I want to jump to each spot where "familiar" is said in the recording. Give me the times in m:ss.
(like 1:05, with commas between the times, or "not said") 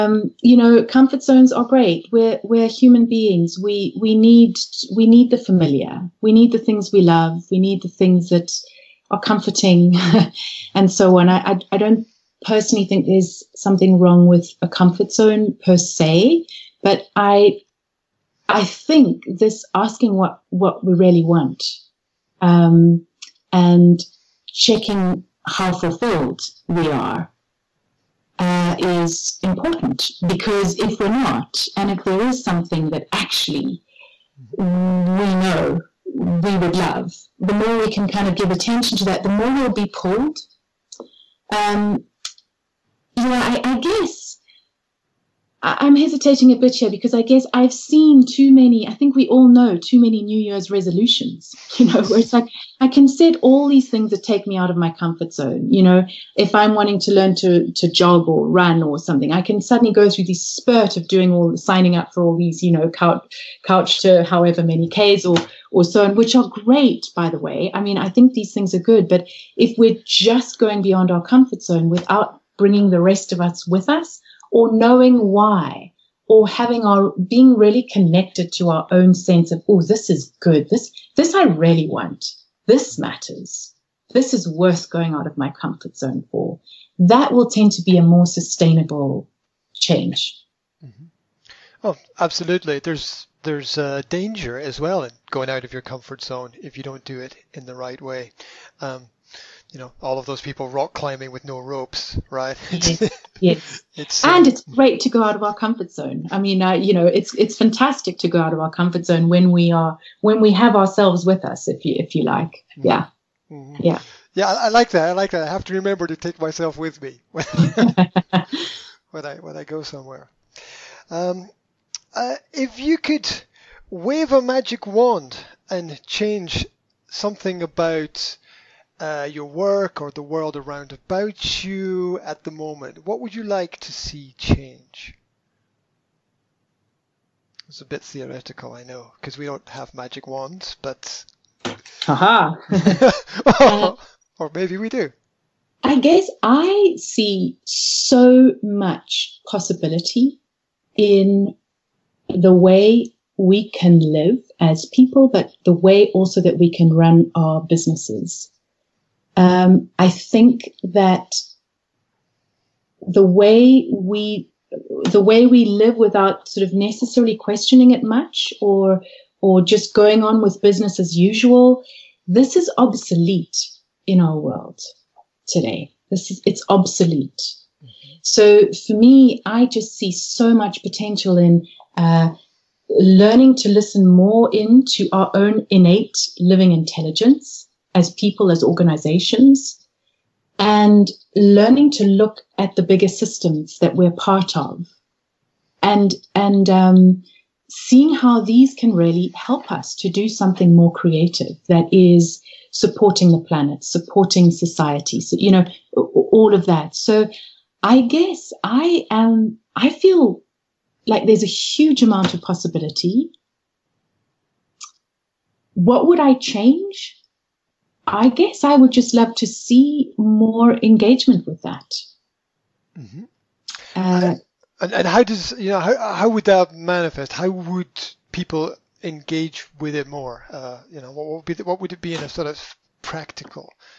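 0:05.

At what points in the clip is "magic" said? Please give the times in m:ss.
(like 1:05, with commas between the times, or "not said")
2:04, 2:19.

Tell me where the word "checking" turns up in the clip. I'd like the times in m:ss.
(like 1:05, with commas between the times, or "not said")
0:24.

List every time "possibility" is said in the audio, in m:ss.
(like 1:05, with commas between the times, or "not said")
2:29, 3:32.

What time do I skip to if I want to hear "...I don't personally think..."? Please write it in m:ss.
0:11.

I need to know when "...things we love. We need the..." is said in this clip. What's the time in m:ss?
0:06.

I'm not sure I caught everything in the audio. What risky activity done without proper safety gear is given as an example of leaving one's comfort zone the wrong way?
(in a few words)
rock climbing.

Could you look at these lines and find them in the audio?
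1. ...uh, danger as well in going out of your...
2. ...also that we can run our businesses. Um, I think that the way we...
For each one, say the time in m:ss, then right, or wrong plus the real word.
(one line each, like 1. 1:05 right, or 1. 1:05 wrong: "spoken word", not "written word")
1. 1:33 right
2. 2:36 right.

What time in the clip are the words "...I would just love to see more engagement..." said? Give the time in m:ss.
3:38.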